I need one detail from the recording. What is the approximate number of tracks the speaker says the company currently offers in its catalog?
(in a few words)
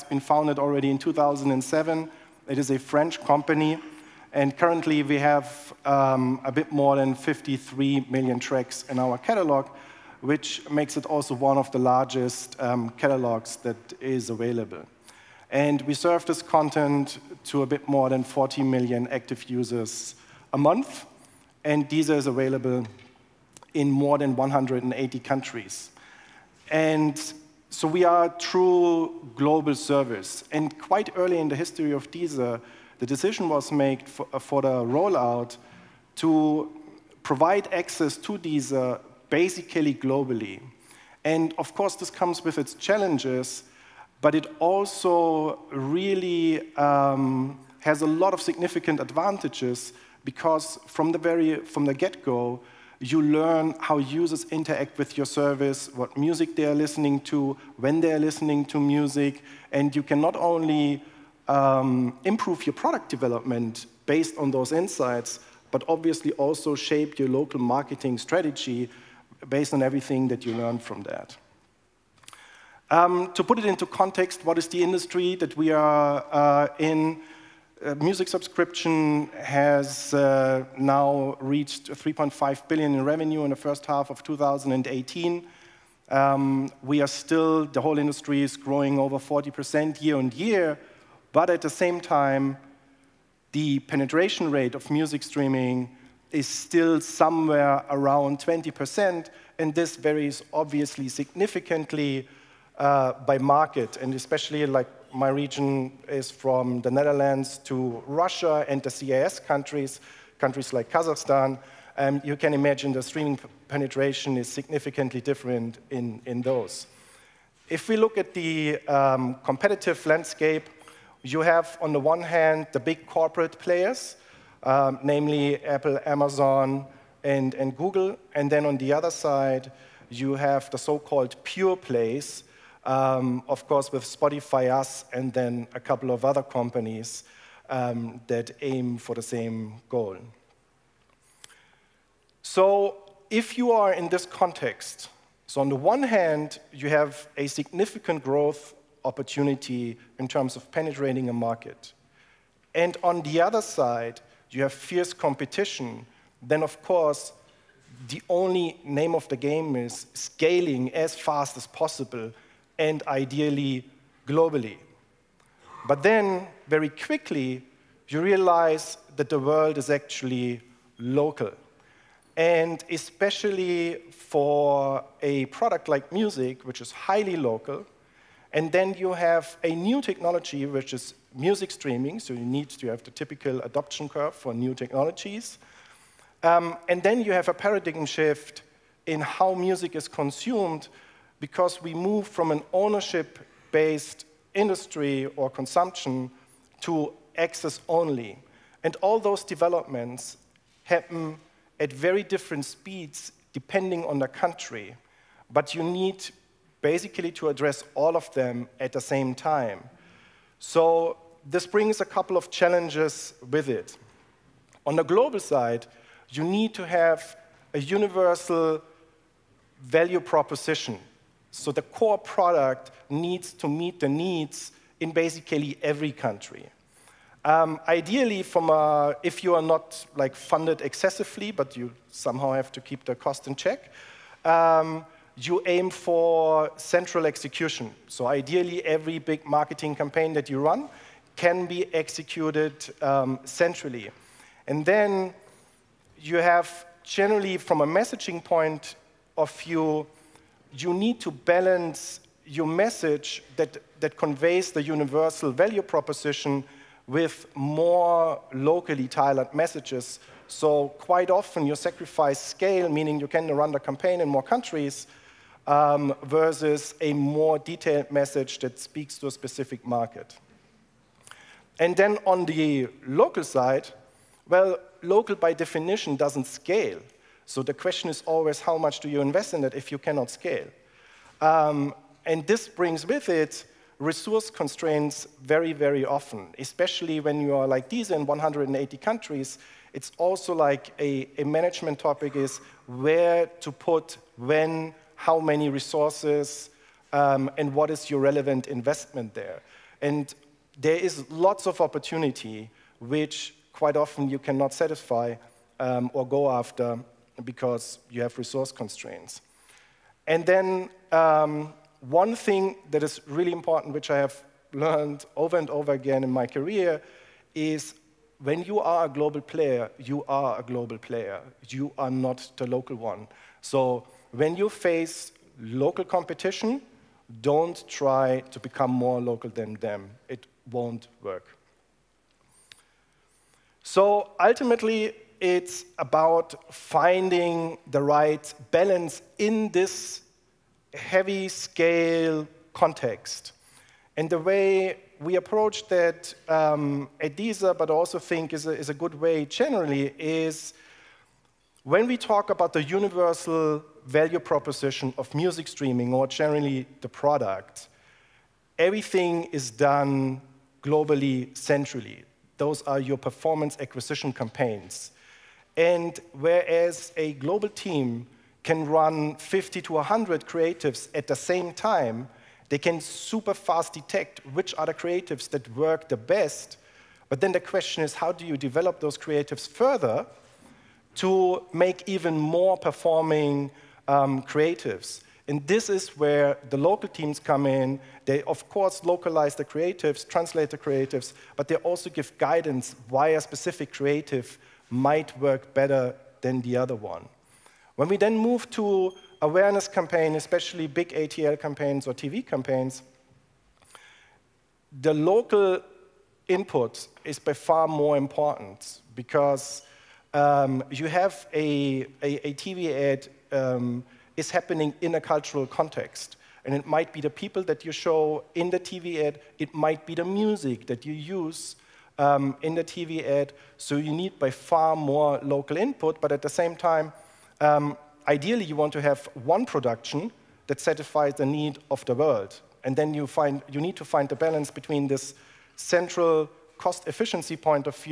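53 million.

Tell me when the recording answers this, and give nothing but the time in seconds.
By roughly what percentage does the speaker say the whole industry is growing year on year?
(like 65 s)
88 s.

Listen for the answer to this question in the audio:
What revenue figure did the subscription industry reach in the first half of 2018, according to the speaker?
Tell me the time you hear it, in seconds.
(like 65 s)
81 s.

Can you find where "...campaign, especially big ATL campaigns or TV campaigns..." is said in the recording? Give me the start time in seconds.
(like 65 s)
399 s.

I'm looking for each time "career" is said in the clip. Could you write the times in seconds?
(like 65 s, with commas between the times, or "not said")
316 s.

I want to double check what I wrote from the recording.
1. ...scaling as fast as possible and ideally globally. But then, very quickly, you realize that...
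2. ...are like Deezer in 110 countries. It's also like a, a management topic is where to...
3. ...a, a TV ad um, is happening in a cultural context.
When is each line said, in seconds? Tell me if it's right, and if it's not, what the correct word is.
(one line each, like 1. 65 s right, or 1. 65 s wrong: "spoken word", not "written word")
1. 160 s right
2. 287 s wrong: "180", not "110"
3. 412 s right.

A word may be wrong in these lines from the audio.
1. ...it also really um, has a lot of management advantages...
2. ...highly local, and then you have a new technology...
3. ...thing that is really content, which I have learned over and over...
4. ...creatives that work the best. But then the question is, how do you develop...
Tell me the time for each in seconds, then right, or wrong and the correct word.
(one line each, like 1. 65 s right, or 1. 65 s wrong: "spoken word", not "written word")
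1. 44 s wrong: "significant", not "management"
2. 176 s right
3. 312 s wrong: "important", not "content"
4. 374 s right.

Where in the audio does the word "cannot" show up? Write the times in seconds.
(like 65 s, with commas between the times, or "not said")
279 s, 304 s.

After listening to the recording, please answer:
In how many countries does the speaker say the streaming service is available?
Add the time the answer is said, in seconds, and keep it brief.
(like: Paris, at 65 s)
more than 180, at 23 s.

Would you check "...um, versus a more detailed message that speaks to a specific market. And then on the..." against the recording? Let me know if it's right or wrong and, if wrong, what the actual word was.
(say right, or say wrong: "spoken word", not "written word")
right.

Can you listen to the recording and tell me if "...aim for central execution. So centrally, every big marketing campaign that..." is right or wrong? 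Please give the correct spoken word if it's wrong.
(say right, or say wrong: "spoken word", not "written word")
wrong: "ideally", not "centrally".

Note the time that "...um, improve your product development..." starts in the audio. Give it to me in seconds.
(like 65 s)
61 s.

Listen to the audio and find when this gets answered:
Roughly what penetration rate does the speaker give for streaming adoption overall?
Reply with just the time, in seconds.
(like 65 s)
98 s.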